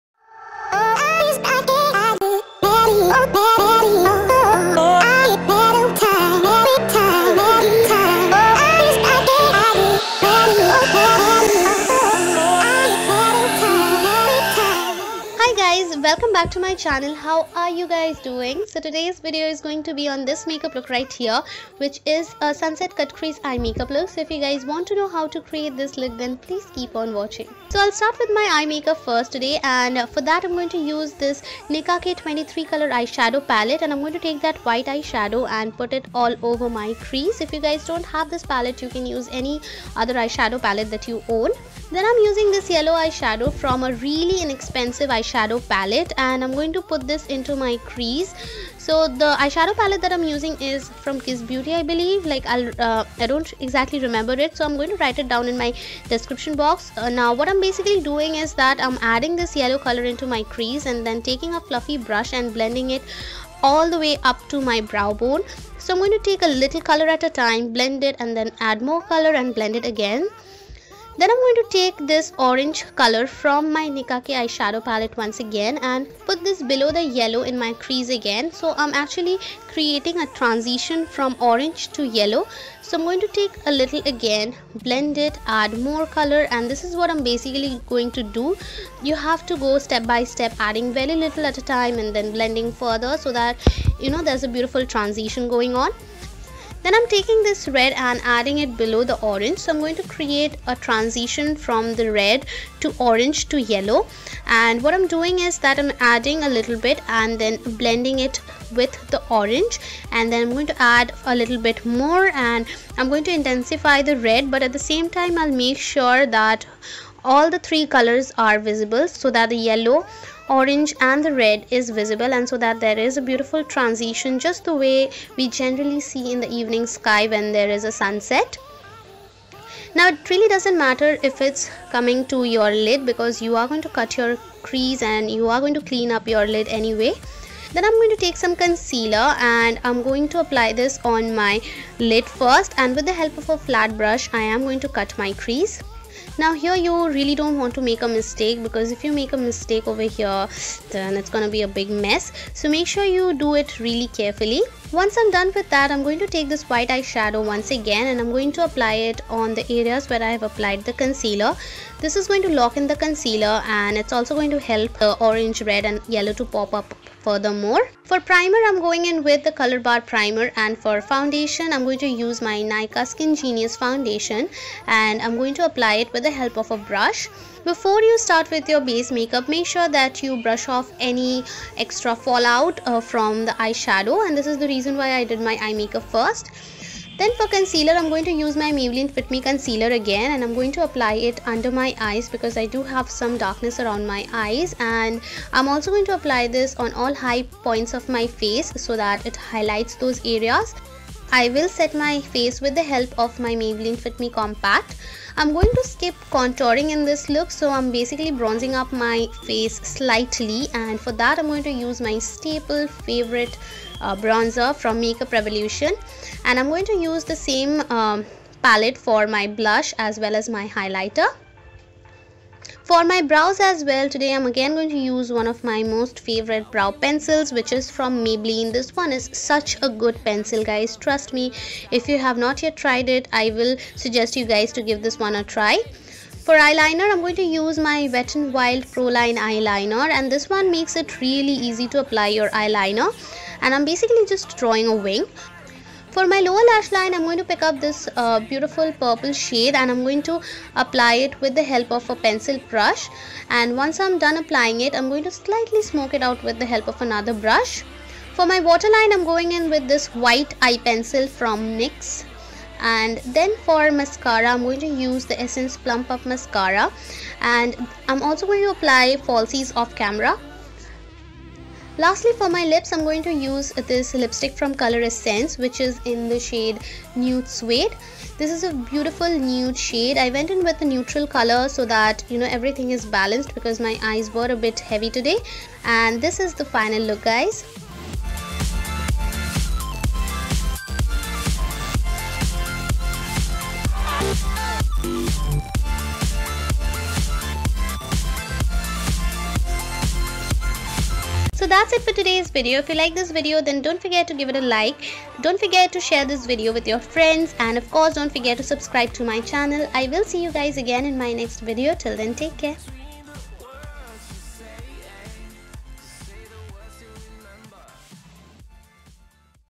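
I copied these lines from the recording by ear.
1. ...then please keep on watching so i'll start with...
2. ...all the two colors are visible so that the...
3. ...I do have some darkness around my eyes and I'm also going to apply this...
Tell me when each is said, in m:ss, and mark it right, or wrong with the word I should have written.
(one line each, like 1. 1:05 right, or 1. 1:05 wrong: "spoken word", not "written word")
1. 0:26 right
2. 1:57 wrong: "three", not "two"
3. 3:12 right.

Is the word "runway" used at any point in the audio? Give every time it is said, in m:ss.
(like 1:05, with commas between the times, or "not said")
not said.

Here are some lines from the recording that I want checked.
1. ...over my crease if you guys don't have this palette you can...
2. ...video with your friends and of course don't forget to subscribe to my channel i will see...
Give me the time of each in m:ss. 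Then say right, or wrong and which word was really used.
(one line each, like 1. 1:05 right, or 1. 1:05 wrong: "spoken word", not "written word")
1. 0:36 right
2. 5:06 right.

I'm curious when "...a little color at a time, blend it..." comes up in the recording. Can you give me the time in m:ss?
1:06.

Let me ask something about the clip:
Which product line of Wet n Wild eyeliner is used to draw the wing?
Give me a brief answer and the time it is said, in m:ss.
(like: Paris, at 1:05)
Proline, at 3:58.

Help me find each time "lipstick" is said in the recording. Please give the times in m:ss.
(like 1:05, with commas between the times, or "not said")
4:34.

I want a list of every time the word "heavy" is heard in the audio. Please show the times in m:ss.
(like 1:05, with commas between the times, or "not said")
4:44.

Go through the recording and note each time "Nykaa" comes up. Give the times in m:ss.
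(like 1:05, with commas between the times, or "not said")
2:52.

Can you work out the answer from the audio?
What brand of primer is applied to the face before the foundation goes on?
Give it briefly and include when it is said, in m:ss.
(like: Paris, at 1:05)
Colorbar, at 2:49.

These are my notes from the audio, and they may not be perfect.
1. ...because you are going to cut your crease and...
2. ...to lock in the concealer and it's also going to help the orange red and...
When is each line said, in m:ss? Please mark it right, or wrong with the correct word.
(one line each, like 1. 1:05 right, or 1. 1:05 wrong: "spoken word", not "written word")
1. 2:13 right
2. 2:42 right.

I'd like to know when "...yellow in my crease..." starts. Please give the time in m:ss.
1:17.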